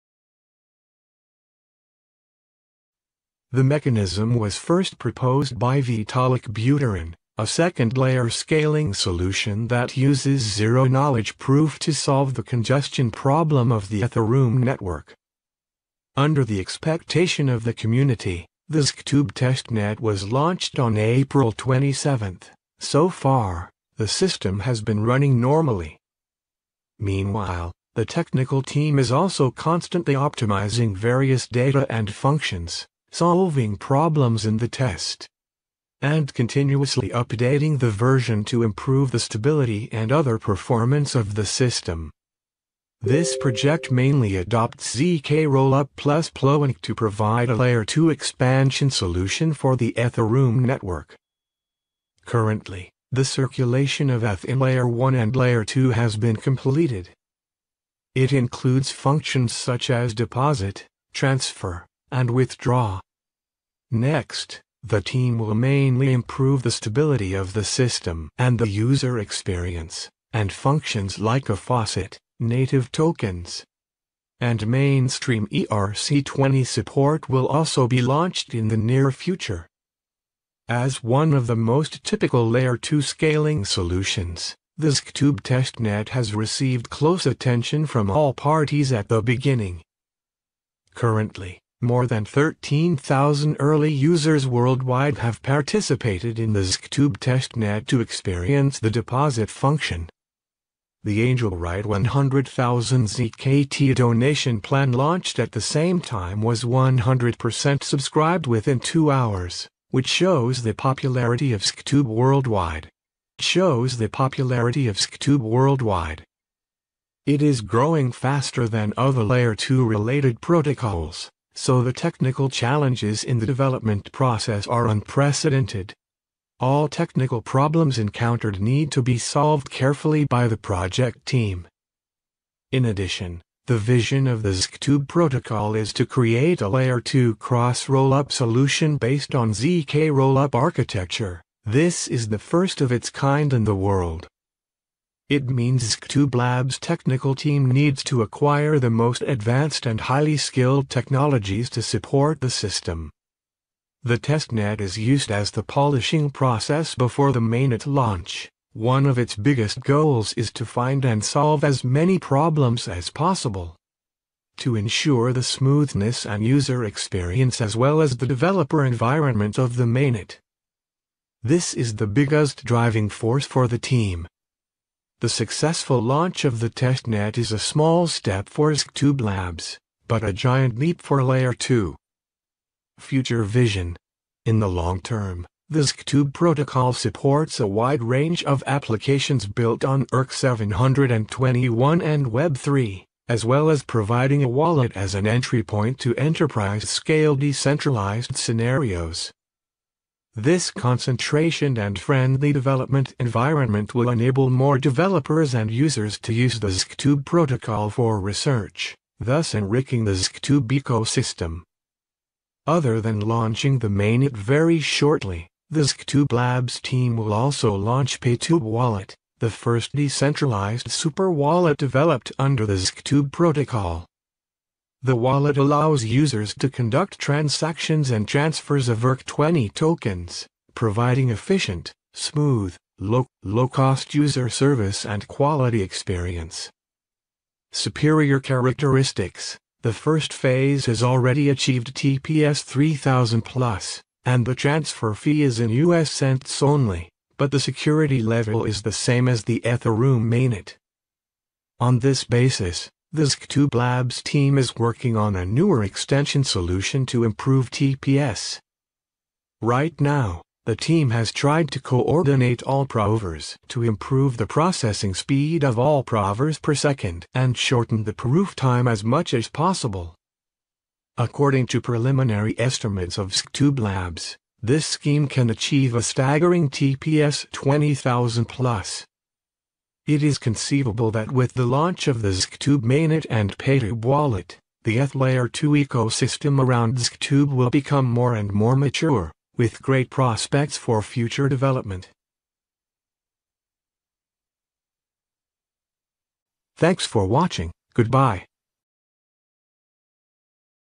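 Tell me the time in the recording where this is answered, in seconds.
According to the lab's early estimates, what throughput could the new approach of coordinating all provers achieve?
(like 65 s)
276 s.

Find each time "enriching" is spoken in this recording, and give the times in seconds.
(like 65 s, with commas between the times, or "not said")
209 s.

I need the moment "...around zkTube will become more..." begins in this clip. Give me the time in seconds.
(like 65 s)
286 s.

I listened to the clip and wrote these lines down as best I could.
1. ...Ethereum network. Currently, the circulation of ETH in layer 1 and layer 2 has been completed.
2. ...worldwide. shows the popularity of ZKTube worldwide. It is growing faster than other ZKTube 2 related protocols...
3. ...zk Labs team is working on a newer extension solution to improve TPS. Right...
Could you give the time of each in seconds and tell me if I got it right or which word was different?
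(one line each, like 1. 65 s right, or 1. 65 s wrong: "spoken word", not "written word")
1. 49 s right
2. 112 s wrong: "Layer", not "ZKTube"
3. 253 s right.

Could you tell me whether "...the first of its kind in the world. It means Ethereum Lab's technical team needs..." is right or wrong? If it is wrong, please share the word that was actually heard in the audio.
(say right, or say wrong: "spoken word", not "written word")
wrong: "ZKTube", not "Ethereum".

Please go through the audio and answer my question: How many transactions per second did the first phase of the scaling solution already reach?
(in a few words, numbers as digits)
3000 plus.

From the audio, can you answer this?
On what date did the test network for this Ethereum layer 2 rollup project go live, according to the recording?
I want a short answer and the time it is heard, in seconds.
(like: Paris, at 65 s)
April 27, at 20 s.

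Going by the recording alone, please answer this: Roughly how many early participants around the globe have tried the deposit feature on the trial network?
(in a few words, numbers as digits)
13,000.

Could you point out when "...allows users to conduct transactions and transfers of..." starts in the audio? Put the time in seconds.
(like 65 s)
225 s.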